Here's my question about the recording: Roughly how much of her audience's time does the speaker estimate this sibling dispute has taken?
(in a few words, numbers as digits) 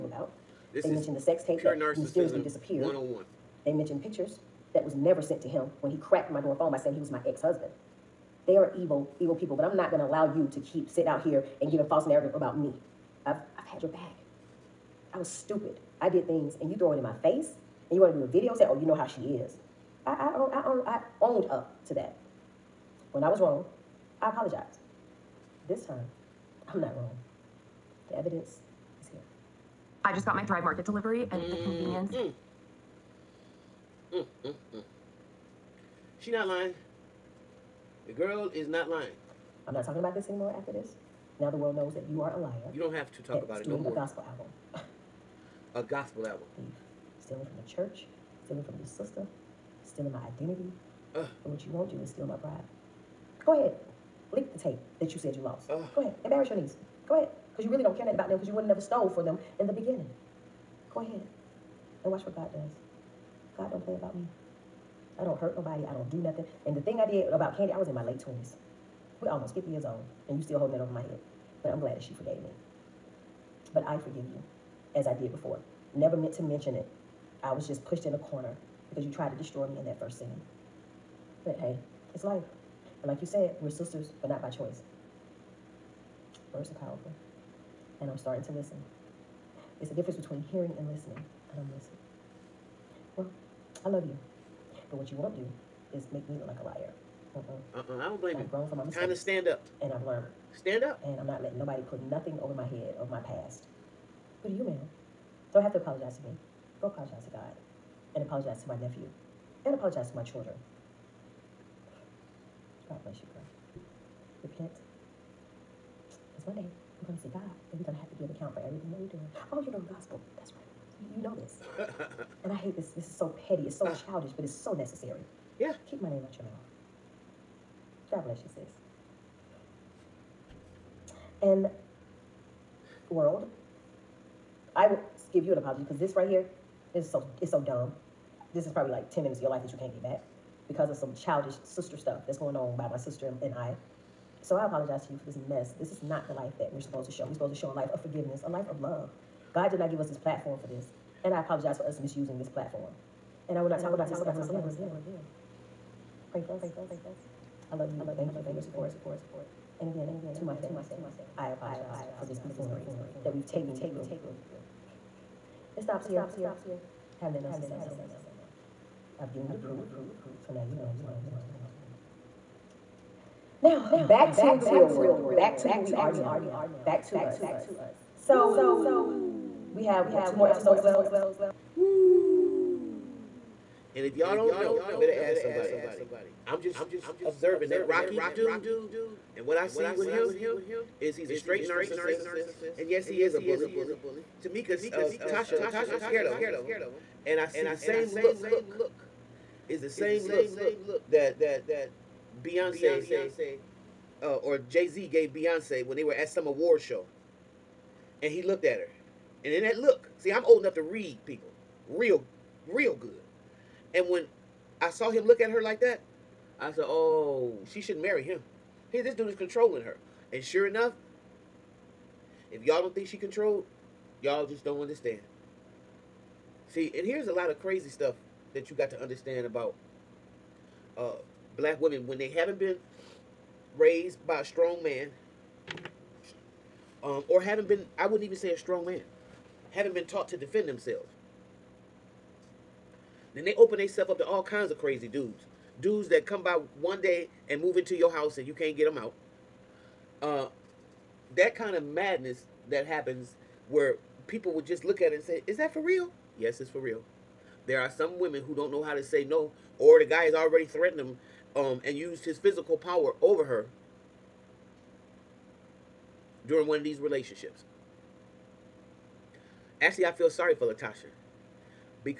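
10 minutes.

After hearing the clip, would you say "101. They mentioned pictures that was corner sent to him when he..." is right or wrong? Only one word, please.
wrong.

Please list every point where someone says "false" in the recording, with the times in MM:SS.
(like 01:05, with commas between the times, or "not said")
00:11.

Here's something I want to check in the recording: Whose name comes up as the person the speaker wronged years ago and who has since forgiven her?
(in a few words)
Kandi.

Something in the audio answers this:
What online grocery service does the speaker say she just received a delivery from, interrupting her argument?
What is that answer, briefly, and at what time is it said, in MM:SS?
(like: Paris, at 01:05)
Thrive Market, at 00:30.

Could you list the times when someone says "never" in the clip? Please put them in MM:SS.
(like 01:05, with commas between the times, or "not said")
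00:04, 00:58, 01:15.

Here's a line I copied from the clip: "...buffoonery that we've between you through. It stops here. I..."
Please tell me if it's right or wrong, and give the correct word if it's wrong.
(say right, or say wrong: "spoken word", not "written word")
wrong: "taken", not "between".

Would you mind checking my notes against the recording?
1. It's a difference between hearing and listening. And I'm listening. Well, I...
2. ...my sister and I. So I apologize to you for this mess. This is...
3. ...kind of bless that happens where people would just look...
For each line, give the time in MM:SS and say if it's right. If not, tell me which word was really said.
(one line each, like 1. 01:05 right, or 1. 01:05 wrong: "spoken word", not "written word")
1. 01:29 right
2. 02:22 right
3. 04:11 wrong: "madness", not "bless".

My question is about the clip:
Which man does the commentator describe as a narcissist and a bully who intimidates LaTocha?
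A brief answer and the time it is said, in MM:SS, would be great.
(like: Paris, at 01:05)
Rocky, at 03:07.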